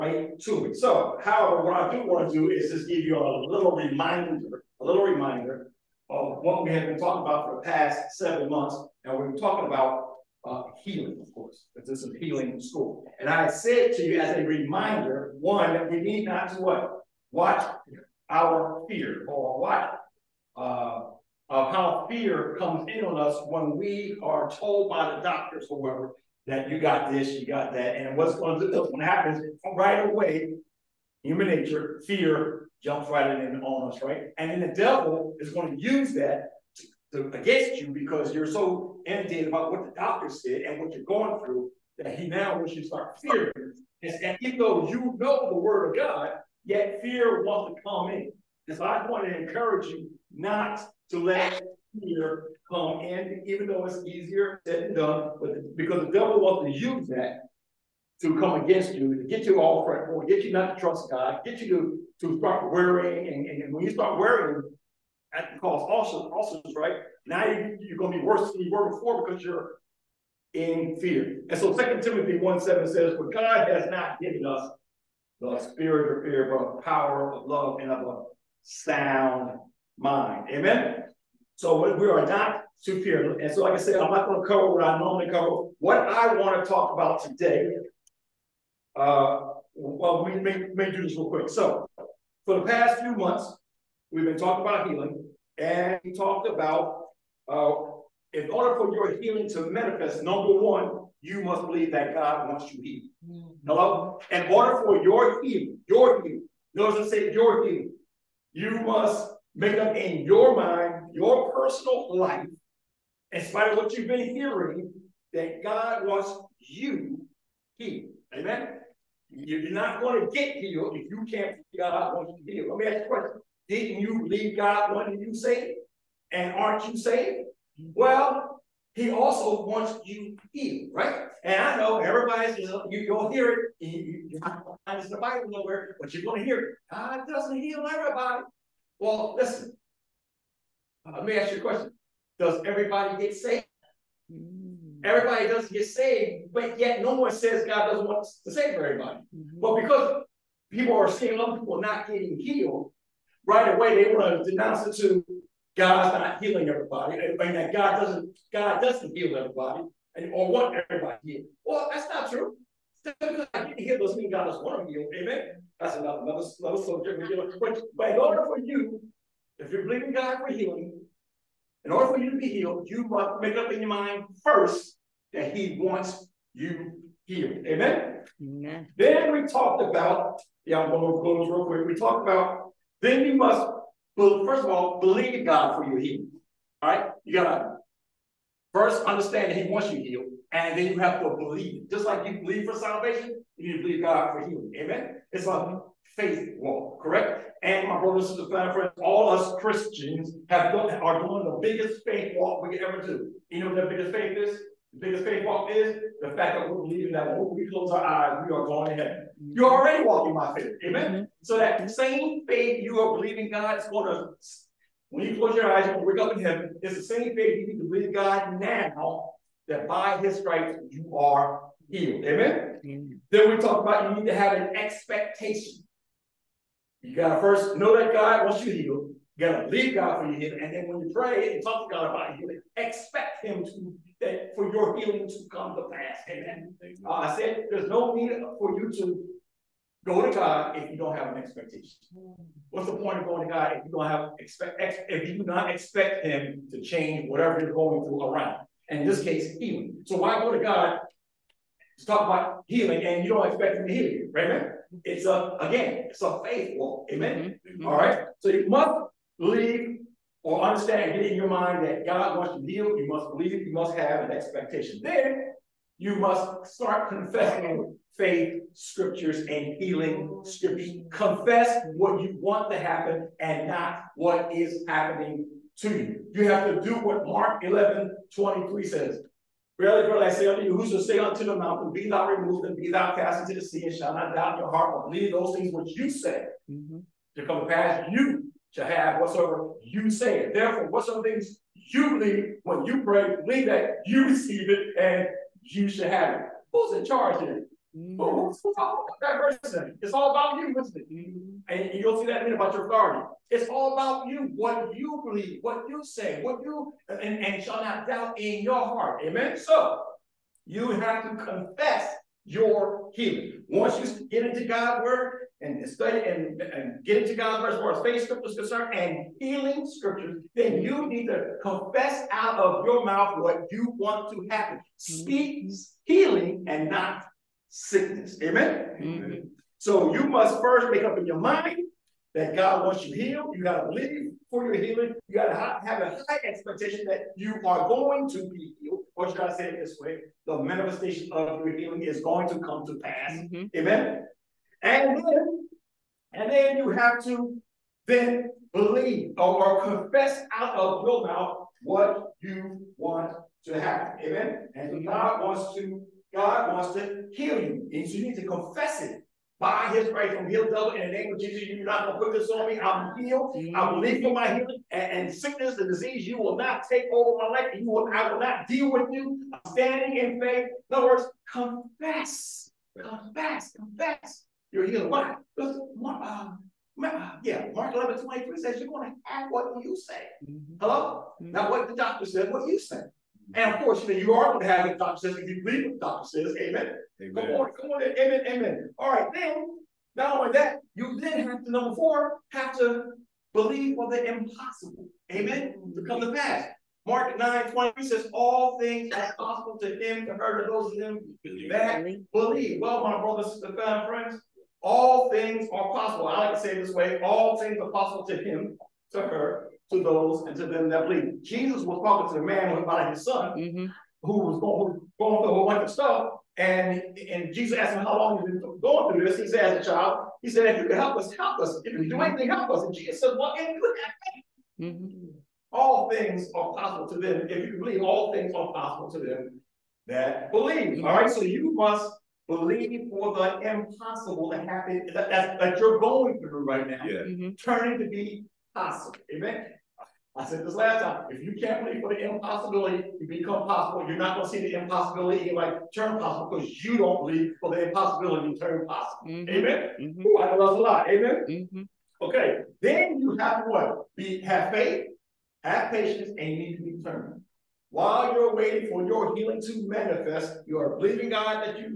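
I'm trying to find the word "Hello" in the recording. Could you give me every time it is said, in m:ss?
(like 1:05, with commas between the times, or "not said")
1:43, 6:20.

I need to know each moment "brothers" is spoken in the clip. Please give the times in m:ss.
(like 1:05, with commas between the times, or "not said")
3:17, 6:43.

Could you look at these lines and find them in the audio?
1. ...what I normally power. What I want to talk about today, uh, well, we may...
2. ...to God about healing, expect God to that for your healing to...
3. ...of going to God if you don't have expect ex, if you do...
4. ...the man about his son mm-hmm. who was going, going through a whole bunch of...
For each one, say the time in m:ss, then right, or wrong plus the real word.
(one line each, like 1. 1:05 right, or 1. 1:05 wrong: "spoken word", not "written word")
1. 1:24 wrong: "cover", not "power"
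2. 3:51 wrong: "Him", not "God"
3. 4:03 right
4. 6:52 right.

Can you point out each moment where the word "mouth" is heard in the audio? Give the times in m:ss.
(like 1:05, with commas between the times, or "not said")
5:23, 5:51.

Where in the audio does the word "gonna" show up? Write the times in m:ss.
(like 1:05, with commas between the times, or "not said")
6:02, 6:18.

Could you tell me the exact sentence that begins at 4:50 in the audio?
Therefore, whatsoever things you believe when you pray, believe that you receive it and you shall have it.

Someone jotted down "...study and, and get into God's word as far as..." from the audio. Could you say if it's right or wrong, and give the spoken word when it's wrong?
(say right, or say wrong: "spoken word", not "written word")
right.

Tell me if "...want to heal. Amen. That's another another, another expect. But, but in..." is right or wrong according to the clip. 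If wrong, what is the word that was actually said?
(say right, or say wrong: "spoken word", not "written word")
wrong: "subject", not "expect".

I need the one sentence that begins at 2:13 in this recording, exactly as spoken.
You, you, it's in the Bible nowhere, but you're going to hear it.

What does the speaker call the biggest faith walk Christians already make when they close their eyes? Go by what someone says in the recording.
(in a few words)
Going to heaven.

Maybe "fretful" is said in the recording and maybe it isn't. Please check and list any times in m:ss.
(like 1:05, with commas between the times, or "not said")
0:59.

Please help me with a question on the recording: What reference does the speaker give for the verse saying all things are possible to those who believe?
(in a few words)
Mark 9:20.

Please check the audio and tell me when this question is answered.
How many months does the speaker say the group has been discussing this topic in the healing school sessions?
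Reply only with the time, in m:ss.
0:08.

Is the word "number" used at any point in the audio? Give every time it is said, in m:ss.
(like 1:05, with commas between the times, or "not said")
1:40, 6:31.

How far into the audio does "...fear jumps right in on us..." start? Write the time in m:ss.
0:32.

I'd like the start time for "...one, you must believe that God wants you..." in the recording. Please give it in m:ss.
1:40.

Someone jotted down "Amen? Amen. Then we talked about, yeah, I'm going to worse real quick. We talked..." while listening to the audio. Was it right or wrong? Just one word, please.
wrong.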